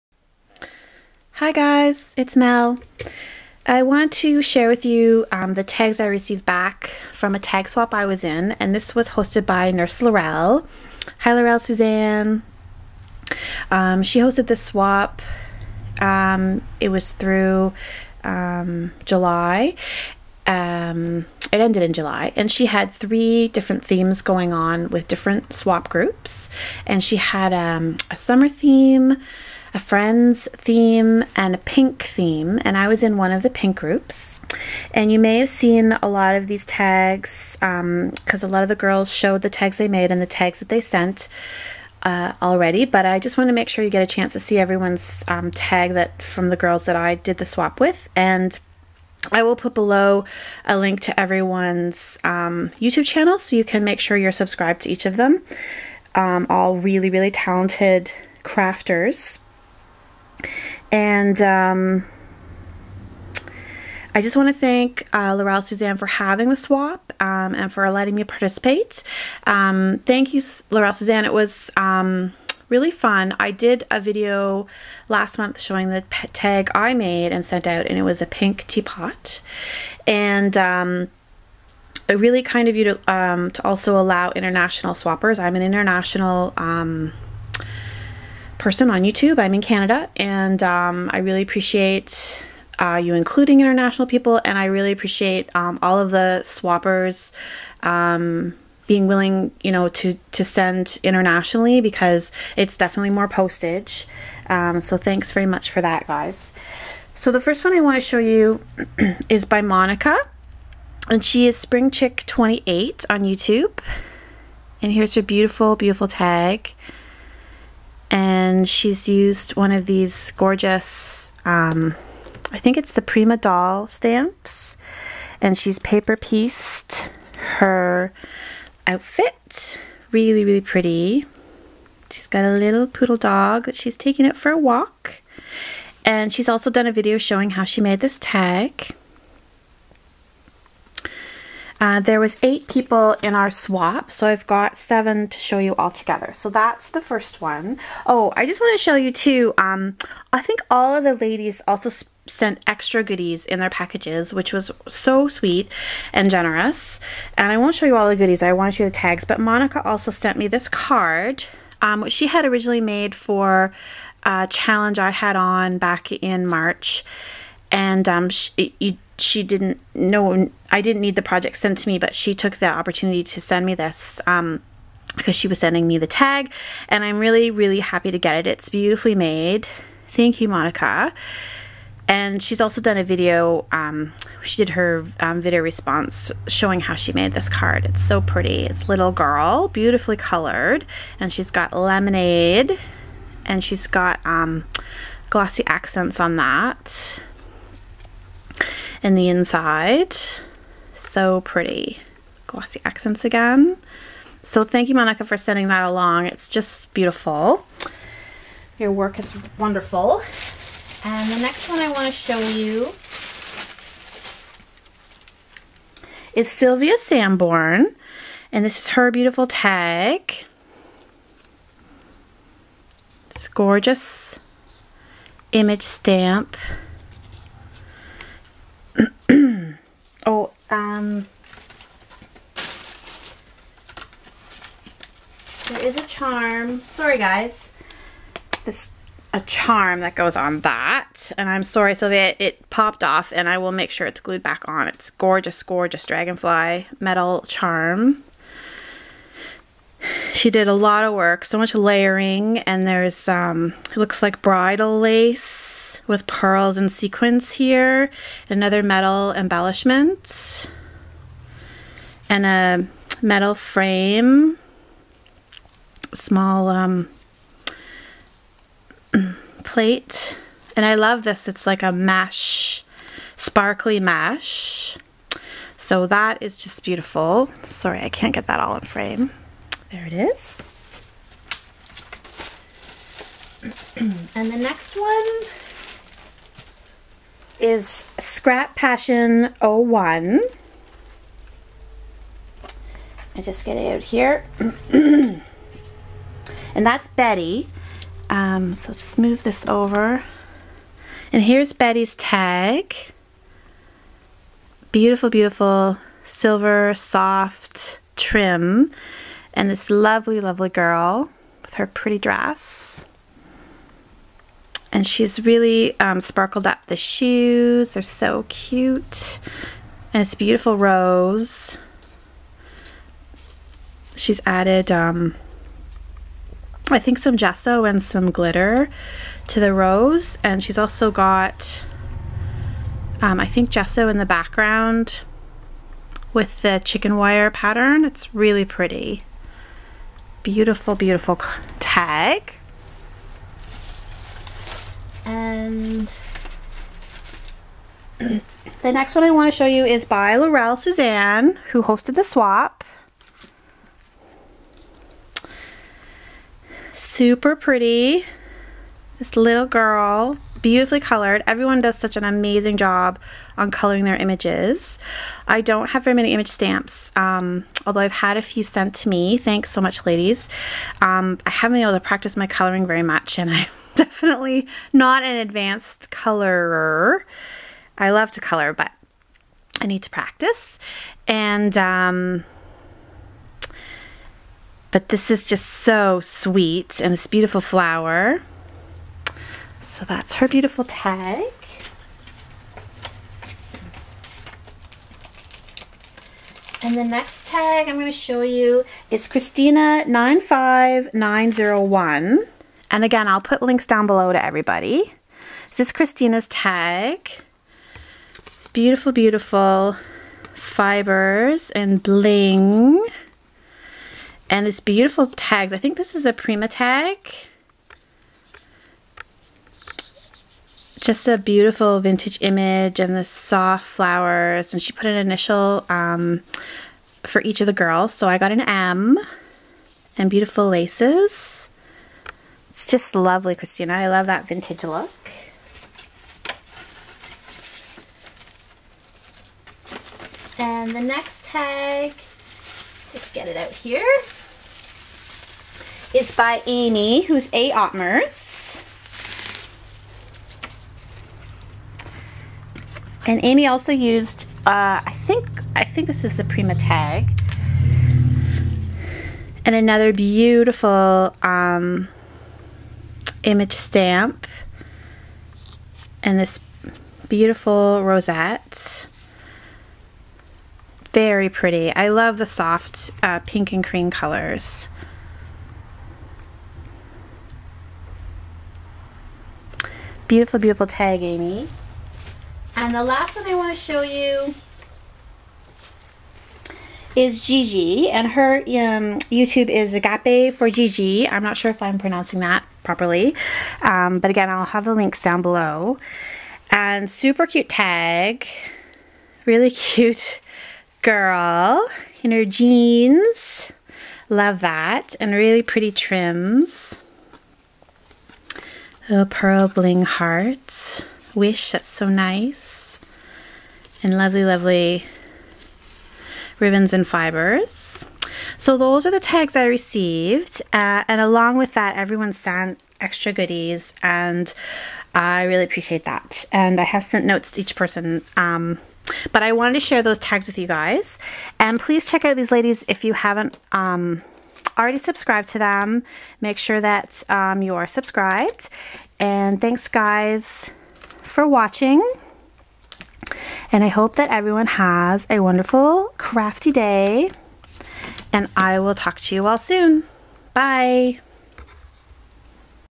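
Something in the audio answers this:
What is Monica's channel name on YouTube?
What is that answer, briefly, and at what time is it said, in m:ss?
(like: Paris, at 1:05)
Spring Chick 28, at 1:51.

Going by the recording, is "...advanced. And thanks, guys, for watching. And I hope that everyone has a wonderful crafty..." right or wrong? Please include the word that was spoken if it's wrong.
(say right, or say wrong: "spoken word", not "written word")
wrong: "subscribed", not "advanced".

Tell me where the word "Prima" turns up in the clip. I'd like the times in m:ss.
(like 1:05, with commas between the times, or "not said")
2:03, 6:56, 7:36.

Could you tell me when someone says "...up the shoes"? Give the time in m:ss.
5:16.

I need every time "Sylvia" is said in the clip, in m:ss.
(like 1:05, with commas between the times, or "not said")
3:36, 4:01.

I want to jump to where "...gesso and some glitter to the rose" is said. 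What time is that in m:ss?
5:27.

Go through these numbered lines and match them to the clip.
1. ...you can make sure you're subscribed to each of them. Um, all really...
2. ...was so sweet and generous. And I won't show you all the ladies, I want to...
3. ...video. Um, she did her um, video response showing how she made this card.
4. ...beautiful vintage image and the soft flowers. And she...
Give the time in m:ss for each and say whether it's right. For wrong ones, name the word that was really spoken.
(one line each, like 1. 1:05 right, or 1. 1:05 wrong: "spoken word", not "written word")
1. 0:53 right
2. 2:34 wrong: "goodies", not "ladies"
3. 3:03 right
4. 7:01 right.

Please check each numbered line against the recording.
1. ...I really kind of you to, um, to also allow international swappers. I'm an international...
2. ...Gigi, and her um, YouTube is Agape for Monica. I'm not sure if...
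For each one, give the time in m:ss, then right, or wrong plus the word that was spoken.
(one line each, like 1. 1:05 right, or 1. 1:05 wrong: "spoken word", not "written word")
1. 1:22 right
2. 8:07 wrong: "Gigi", not "Monica".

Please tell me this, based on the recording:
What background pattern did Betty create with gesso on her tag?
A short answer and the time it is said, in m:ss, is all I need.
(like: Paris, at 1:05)
Chicken wire, at 5:36.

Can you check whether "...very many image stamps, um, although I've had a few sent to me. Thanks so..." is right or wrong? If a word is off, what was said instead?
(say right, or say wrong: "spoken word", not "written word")
right.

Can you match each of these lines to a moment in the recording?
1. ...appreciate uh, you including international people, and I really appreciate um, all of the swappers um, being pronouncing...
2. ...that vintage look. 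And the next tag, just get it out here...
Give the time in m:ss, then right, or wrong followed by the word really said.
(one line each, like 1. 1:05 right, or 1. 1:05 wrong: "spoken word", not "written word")
1. 1:31 wrong: "willing", not "pronouncing"
2. 7:14 right.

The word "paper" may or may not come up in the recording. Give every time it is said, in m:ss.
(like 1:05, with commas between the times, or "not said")
2:05.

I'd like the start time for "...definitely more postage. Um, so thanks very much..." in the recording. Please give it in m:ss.
1:42.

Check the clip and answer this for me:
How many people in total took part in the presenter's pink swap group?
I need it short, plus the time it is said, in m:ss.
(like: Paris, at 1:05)
8, at 2:22.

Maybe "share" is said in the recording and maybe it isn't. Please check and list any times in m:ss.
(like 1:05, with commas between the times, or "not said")
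0:04, 8:49.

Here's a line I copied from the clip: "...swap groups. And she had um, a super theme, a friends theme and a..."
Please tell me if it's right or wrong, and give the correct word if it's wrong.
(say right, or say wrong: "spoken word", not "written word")
wrong: "summer", not "super".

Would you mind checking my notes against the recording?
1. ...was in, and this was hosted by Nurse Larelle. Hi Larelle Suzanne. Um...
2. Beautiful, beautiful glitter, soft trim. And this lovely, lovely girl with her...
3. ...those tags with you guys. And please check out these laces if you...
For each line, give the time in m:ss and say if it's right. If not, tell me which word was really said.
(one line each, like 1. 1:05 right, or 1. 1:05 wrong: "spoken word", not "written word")
1. 0:08 right
2. 5:04 wrong: "silver", not "glitter"
3. 8:50 wrong: "ladies", not "laces".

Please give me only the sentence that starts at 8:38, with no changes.
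So those are the tags I received.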